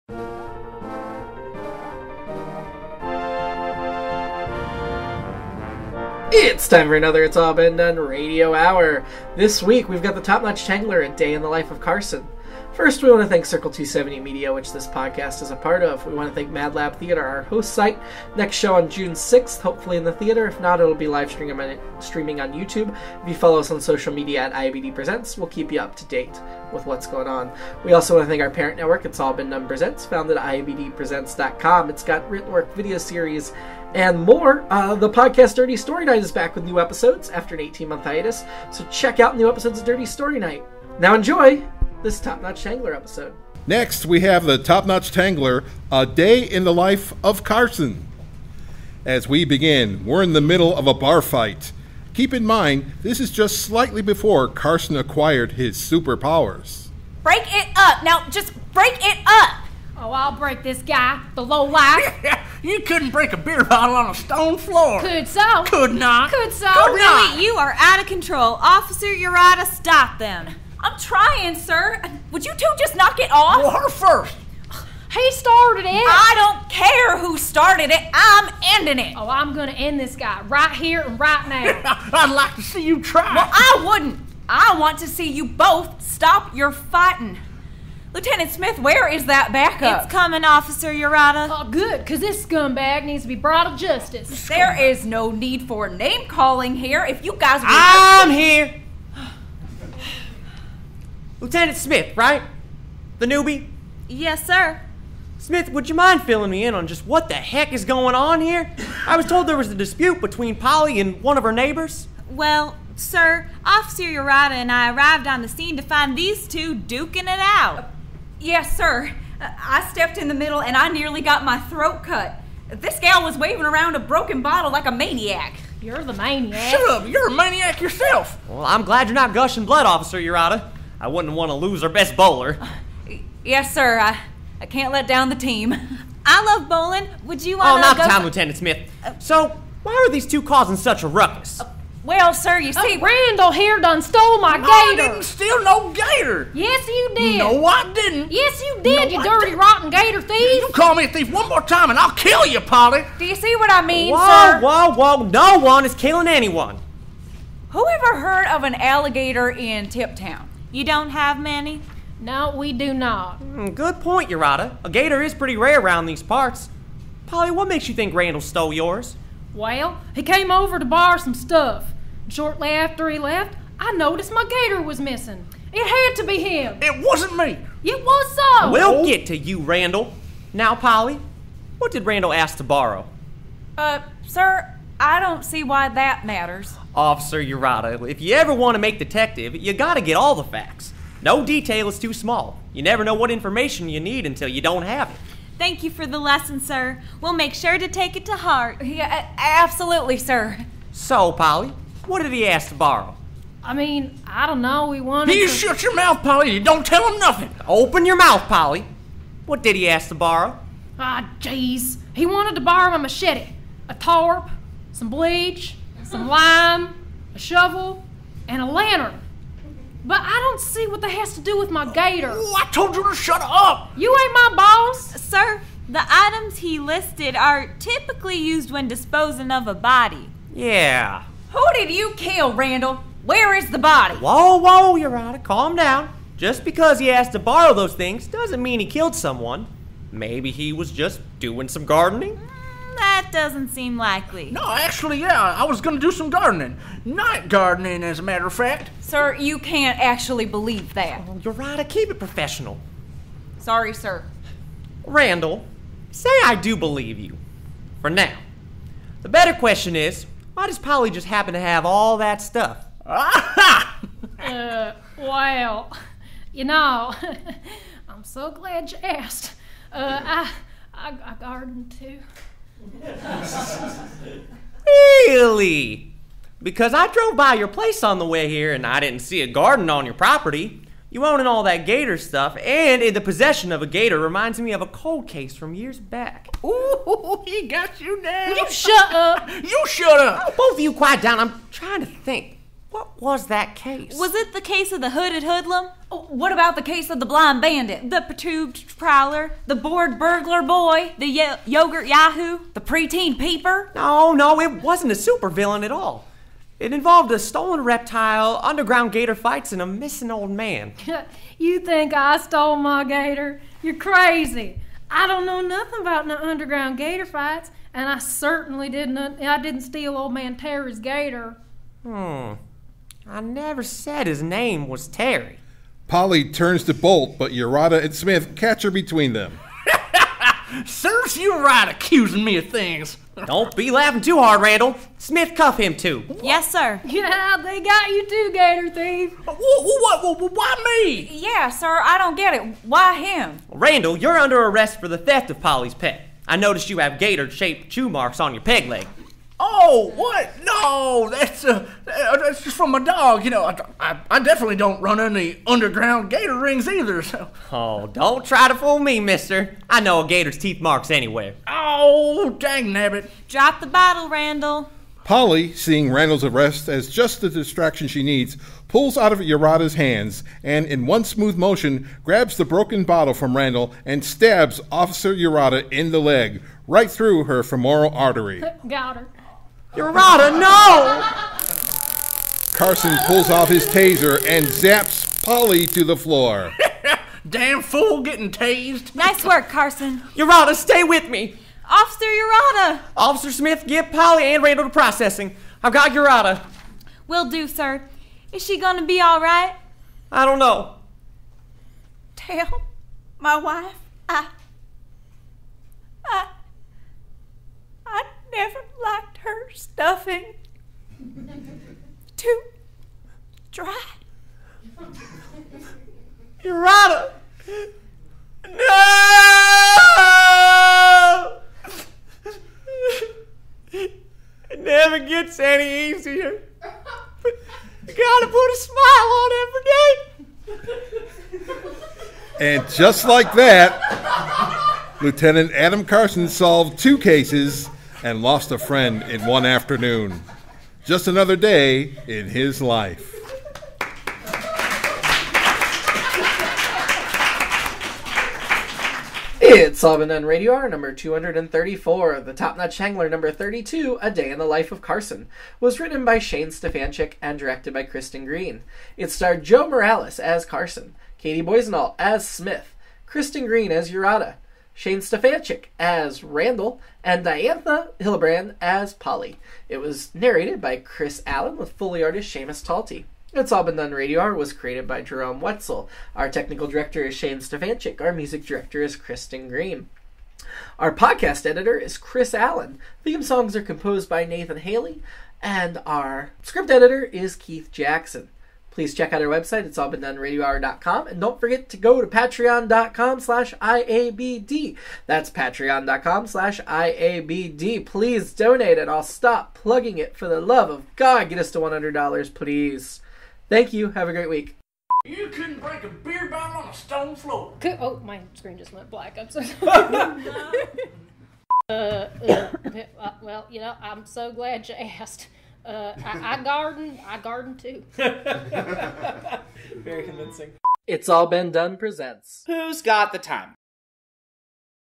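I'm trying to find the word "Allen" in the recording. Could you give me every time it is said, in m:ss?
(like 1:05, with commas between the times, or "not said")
7:51, 8:02.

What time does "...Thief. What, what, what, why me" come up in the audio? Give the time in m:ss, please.
5:38.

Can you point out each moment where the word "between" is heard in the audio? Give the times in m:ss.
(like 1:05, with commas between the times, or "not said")
1:50, 5:28.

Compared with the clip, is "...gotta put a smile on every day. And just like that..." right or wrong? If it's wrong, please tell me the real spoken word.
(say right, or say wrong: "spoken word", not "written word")
right.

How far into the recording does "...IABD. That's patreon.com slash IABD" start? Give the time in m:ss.
8:13.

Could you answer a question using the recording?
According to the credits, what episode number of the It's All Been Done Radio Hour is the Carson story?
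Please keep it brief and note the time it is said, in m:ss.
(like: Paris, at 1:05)
234, at 7:31.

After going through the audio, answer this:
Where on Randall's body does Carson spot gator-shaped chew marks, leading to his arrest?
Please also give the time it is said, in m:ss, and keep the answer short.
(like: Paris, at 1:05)
Peg leg, at 5:48.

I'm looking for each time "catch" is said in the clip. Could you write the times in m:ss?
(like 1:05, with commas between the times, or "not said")
5:28.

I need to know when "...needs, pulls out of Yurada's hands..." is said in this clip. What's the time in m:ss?
6:08.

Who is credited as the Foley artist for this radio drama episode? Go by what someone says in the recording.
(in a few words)
Seamus Talty.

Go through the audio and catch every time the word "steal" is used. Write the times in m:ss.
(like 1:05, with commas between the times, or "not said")
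2:25, 5:19.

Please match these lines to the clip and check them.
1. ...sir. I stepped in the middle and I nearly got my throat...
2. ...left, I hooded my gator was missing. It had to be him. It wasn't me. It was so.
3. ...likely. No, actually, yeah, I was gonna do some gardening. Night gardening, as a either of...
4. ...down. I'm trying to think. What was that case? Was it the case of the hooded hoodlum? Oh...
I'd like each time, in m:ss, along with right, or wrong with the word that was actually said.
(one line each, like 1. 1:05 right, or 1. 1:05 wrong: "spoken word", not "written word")
1. 1:58 right
2. 2:53 wrong: "noticed", not "hooded"
3. 4:03 wrong: "matter", not "either"
4. 4:51 right.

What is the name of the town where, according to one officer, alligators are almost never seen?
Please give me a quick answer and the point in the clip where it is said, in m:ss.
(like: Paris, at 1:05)
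Tiptown, at 2:39.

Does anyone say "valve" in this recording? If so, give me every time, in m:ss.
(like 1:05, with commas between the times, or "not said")
not said.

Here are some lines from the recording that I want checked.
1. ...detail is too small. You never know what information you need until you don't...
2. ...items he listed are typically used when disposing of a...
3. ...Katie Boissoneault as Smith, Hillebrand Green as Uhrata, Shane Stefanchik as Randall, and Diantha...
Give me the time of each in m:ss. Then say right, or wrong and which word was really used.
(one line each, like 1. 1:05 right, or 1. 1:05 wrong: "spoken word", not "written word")
1. 3:11 right
2. 3:46 right
3. 7:41 wrong: "Kristin", not "Hillebrand".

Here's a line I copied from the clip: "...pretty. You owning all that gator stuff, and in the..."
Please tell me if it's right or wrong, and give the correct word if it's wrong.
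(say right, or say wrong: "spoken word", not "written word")
wrong: "property", not "pretty".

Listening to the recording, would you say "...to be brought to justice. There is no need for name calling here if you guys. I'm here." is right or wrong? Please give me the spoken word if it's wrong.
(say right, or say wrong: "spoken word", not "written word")
right.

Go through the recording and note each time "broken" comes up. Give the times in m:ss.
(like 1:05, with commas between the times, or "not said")
2:03, 6:12.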